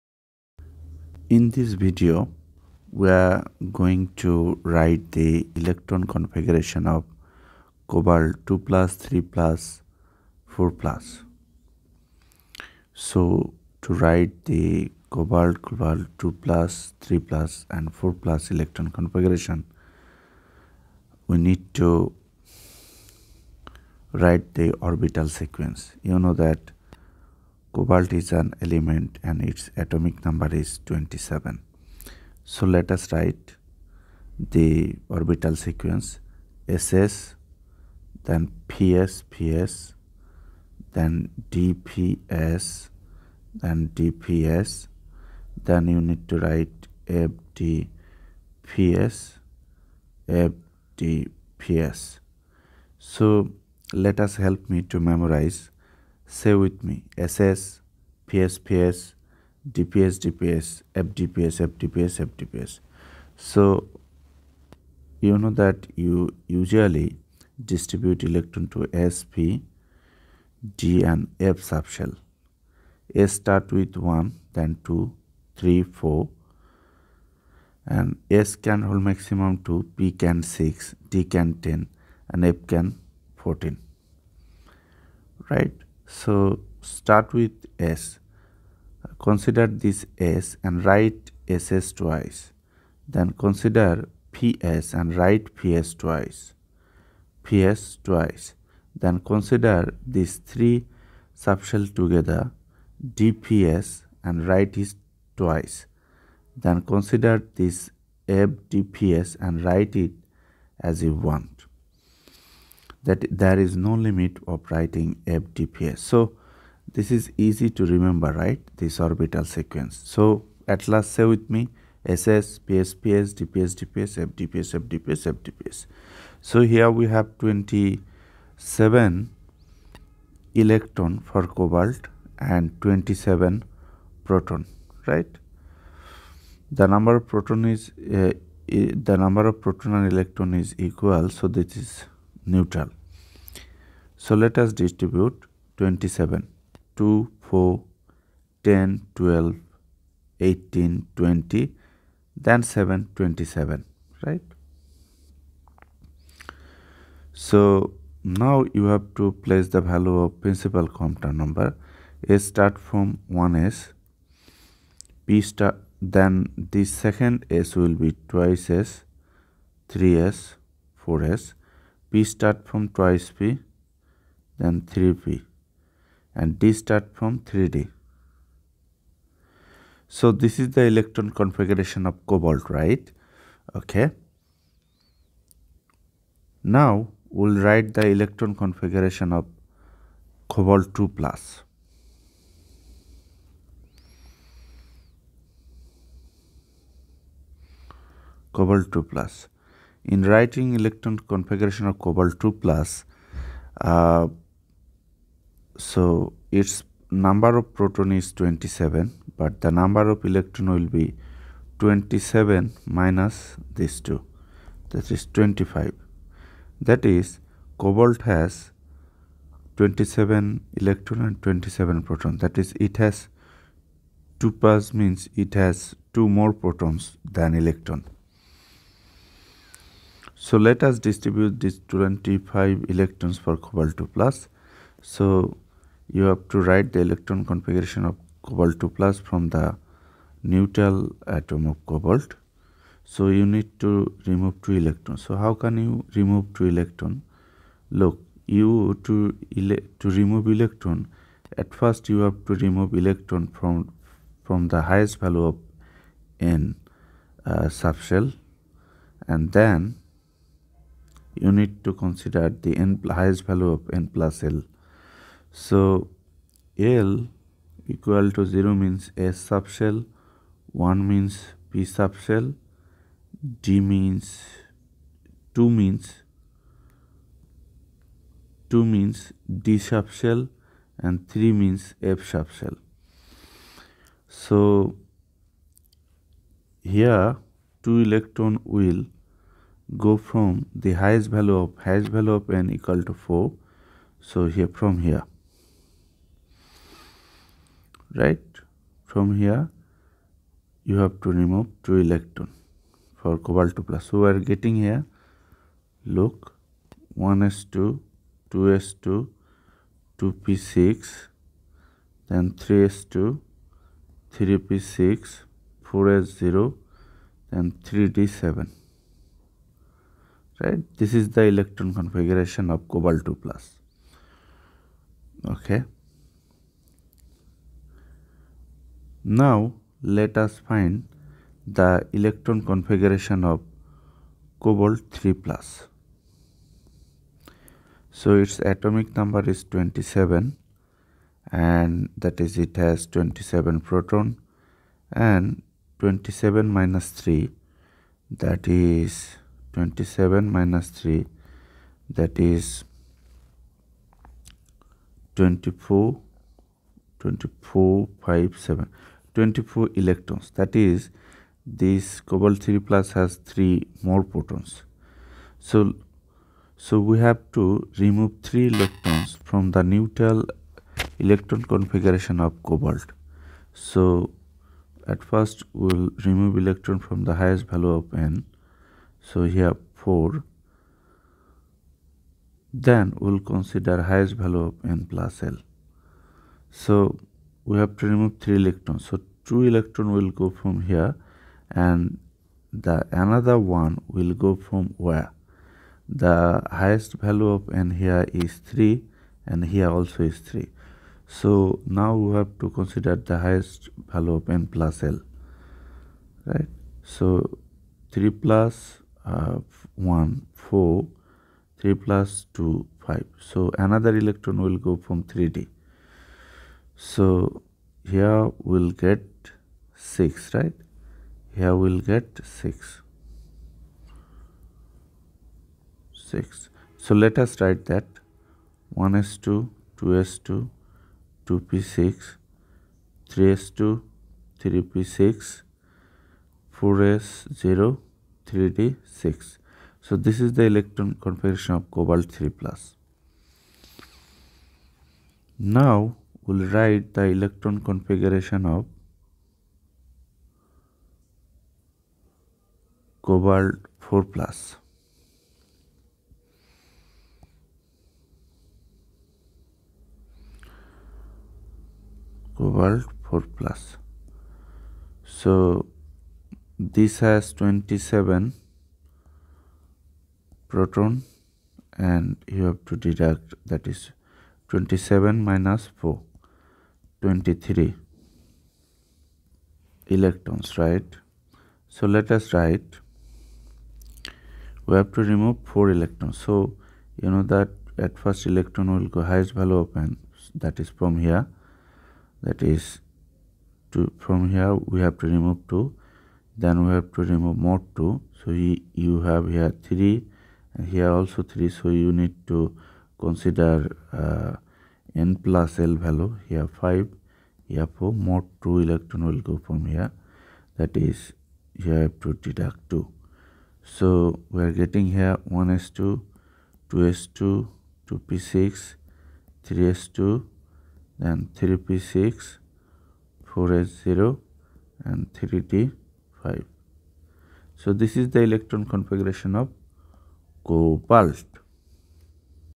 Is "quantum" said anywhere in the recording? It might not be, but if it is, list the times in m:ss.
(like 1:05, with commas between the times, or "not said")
2:40.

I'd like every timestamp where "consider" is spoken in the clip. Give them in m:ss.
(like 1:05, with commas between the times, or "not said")
1:29, 1:33, 1:39, 1:46, 4:21, 6:23, 6:42, 8:23.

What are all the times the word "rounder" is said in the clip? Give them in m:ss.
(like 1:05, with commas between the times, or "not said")
not said.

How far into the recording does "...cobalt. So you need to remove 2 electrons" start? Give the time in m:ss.
4:01.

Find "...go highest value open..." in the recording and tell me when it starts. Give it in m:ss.
8:09.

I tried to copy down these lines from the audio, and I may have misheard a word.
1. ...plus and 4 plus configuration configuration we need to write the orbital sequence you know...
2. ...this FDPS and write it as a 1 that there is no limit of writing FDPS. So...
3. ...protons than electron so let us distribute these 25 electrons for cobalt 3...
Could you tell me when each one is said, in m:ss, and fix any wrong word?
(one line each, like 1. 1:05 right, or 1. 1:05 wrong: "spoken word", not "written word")
1. 0:17 wrong: "electron", not "configuration"
2. 1:47 right
3. 3:46 wrong: "2", not "3".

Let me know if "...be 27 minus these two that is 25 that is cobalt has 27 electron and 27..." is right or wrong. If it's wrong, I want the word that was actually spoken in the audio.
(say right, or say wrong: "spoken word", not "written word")
right.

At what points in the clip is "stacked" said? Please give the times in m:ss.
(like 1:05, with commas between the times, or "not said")
not said.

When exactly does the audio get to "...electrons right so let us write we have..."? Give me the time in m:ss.
8:00.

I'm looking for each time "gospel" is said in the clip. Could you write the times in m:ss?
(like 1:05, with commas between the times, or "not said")
not said.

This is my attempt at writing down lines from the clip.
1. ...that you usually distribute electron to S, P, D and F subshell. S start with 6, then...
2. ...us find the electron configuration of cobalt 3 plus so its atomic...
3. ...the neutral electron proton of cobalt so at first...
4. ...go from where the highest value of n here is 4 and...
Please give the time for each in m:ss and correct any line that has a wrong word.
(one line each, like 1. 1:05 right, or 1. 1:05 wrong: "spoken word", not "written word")
1. 1:05 wrong: "1", not "6"
2. 5:30 right
3. 6:09 wrong: "configuration", not "proton"
4. 6:34 wrong: "3", not "4".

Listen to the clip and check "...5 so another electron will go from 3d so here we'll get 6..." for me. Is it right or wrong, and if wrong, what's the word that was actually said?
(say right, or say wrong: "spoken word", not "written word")
right.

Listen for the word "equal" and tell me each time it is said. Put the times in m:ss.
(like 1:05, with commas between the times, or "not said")
2:20, 4:27, 4:52.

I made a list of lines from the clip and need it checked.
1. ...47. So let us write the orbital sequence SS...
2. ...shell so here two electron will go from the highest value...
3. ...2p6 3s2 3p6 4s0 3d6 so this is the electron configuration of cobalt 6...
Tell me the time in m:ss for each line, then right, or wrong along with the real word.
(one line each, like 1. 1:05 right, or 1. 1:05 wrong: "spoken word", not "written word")
1. 0:30 wrong: "27", not "47"
2. 4:42 right
3. 7:11 wrong: "3", not "6".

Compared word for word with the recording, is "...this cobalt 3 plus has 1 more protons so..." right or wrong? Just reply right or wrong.
wrong.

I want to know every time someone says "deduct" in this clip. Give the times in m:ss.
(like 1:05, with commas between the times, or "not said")
7:52, 8:32.